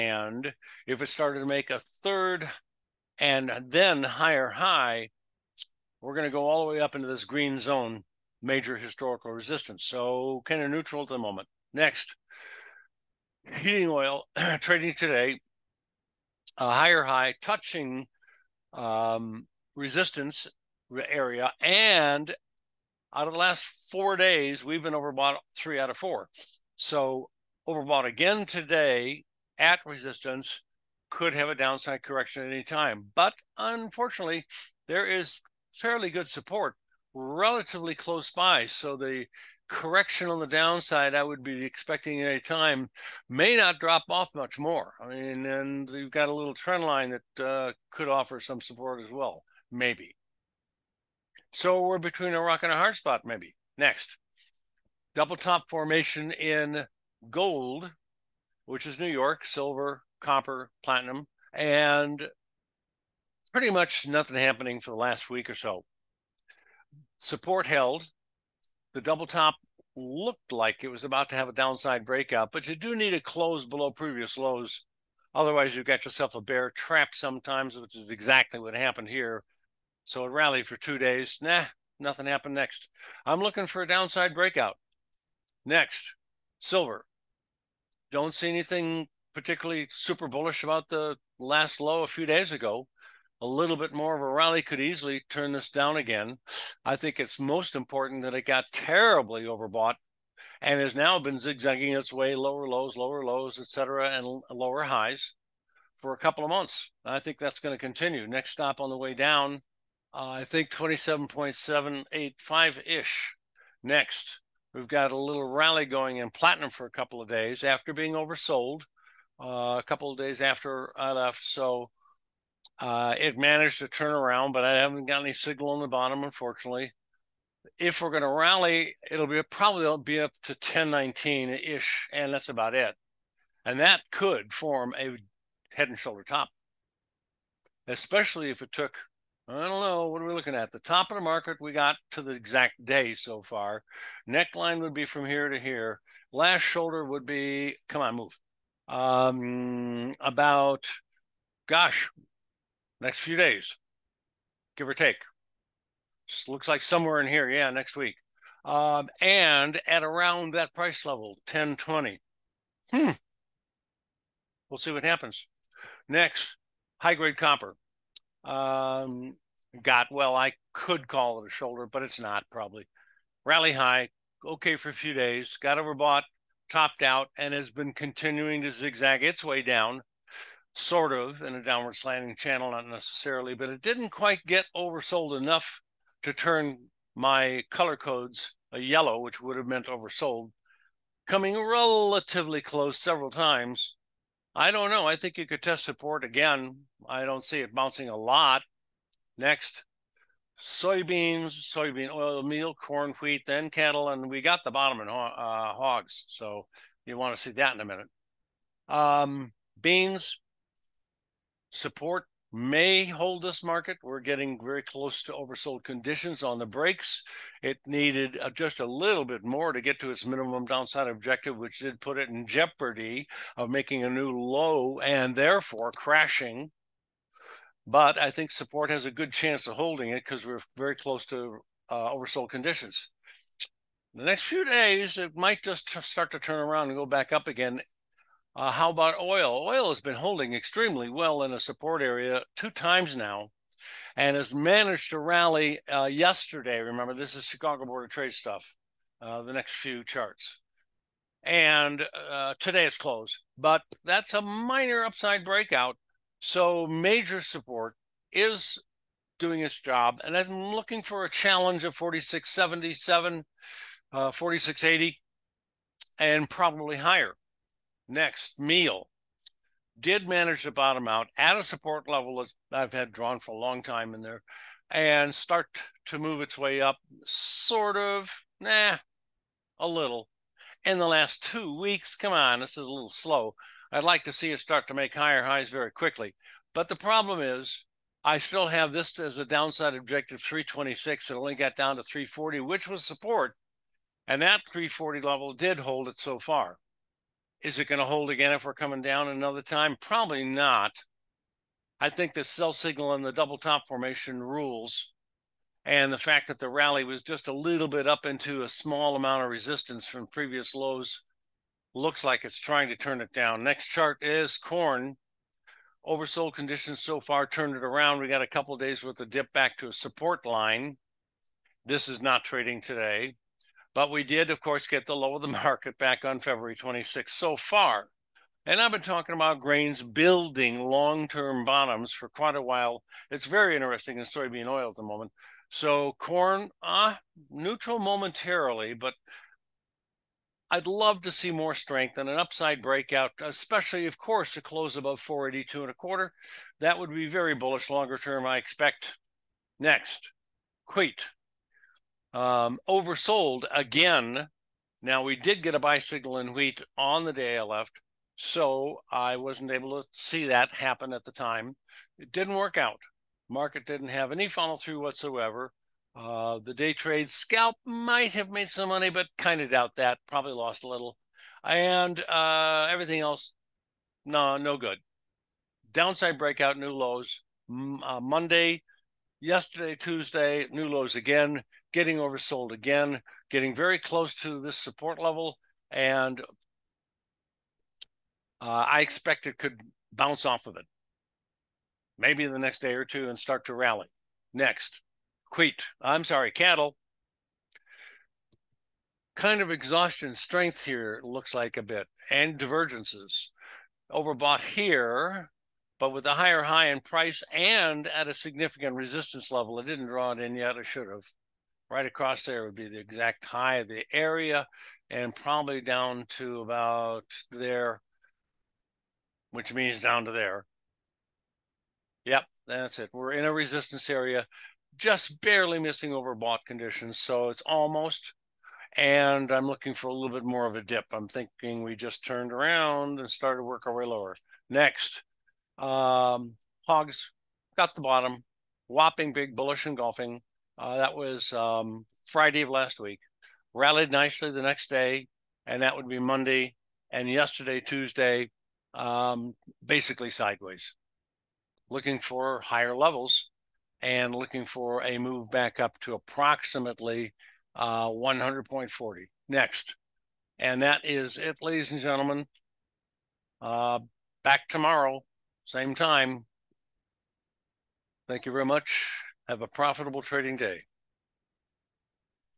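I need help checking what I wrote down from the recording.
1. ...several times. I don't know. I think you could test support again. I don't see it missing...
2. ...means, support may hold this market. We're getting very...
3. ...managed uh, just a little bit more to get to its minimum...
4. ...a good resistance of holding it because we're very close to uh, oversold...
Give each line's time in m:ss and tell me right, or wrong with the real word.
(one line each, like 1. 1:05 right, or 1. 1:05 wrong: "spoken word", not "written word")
1. 3:12 wrong: "bouncing", not "missing"
2. 3:29 wrong: "beans", not "means"
3. 3:37 wrong: "needed", not "managed"
4. 3:49 wrong: "chance", not "resistance".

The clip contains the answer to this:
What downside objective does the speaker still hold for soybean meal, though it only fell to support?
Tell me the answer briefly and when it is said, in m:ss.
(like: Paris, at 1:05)
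326, at 4:50.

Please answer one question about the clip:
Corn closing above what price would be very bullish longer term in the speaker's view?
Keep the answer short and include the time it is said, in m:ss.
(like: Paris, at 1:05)
482 1/4, at 5:45.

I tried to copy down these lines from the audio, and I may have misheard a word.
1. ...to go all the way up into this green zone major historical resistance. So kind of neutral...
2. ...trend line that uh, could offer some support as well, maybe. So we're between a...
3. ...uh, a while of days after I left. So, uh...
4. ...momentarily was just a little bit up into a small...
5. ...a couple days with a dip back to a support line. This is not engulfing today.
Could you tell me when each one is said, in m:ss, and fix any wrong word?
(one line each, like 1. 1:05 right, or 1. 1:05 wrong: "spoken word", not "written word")
1. 0:06 right
2. 0:46 right
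3. 1:59 wrong: "couple", not "while"
4. 5:06 wrong: "rally", not "momentarily"
5. 5:18 wrong: "trading", not "engulfing".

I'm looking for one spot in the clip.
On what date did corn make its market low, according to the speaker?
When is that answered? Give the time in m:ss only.
5:26.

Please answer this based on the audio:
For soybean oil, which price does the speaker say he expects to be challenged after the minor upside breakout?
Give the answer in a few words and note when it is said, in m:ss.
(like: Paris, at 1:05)
4677, at 4:21.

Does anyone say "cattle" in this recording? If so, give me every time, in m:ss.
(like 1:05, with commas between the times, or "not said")
3:23, 6:36.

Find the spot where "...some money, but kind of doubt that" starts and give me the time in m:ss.
6:08.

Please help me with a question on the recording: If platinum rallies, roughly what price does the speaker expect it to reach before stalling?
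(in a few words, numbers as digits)
1019.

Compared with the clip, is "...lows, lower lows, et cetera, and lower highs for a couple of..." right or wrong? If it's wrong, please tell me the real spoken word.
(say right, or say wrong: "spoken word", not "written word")
right.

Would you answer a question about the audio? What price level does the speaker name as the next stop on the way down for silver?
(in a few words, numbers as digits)
27.785.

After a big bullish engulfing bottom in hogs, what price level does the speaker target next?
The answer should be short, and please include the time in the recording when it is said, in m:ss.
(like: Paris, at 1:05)
100.40, at 7:38.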